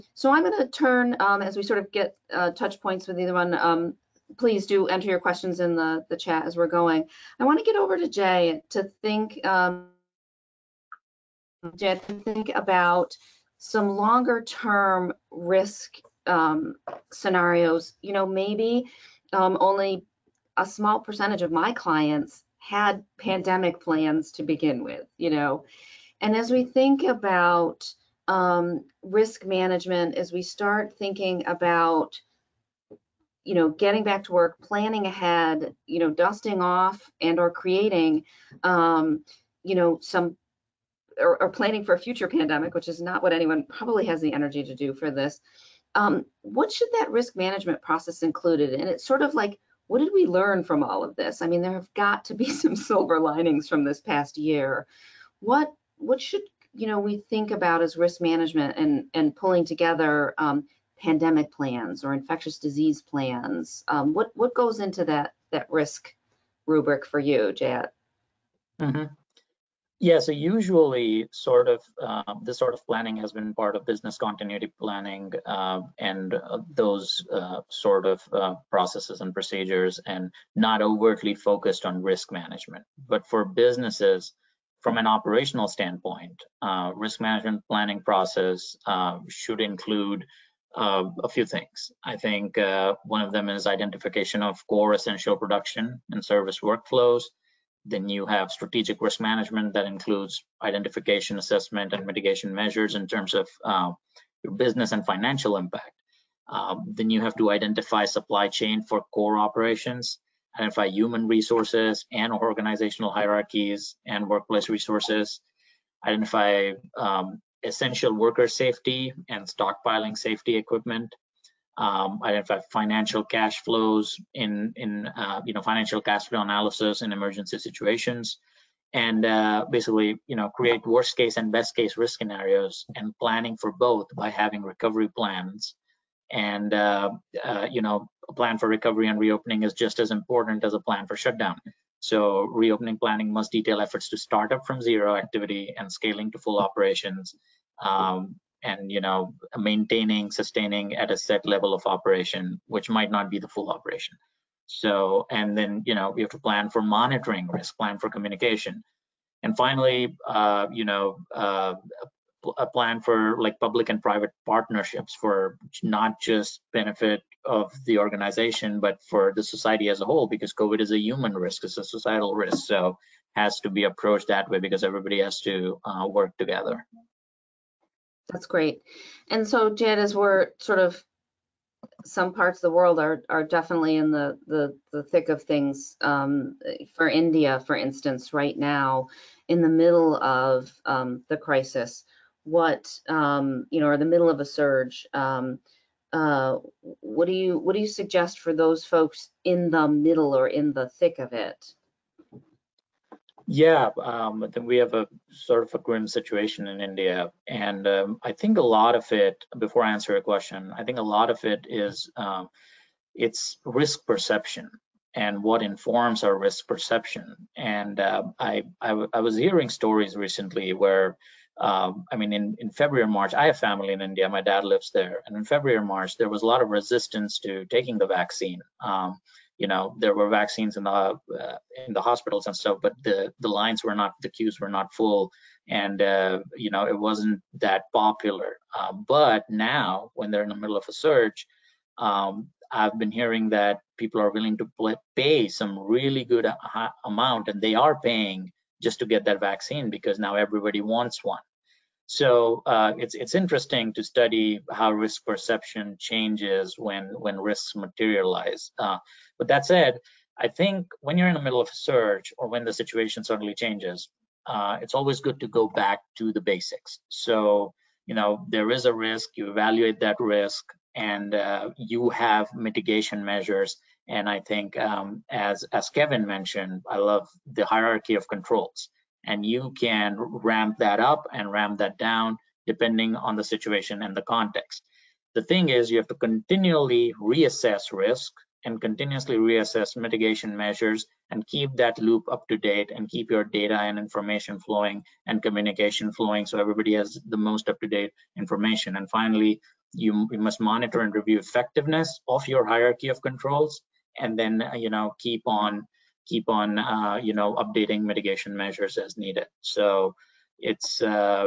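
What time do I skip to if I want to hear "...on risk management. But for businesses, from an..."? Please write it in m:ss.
1:21.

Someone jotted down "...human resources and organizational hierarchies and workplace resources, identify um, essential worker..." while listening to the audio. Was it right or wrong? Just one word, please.
right.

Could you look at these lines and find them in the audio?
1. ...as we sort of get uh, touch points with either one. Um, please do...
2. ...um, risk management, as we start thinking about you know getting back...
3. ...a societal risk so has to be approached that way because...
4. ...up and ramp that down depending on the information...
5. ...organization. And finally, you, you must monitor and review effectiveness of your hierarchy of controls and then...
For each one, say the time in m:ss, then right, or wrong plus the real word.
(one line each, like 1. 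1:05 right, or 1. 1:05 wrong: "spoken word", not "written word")
1. 0:01 right
2. 0:28 right
3. 2:51 right
4. 4:40 wrong: "situation", not "information"
5. 4:58 wrong: "information", not "organization".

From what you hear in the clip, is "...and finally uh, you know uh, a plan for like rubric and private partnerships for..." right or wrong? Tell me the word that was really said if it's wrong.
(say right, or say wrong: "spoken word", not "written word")
wrong: "public", not "rubric".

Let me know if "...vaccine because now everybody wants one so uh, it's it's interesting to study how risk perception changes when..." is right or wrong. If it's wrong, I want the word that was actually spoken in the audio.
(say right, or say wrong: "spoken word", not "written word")
right.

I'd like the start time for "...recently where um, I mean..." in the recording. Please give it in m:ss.
3:40.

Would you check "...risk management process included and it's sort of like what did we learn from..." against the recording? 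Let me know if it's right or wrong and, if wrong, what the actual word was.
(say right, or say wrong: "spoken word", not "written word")
right.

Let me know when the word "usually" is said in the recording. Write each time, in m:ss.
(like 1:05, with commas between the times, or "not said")
1:10.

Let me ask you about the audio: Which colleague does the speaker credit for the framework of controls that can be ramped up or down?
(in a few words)
Kevin.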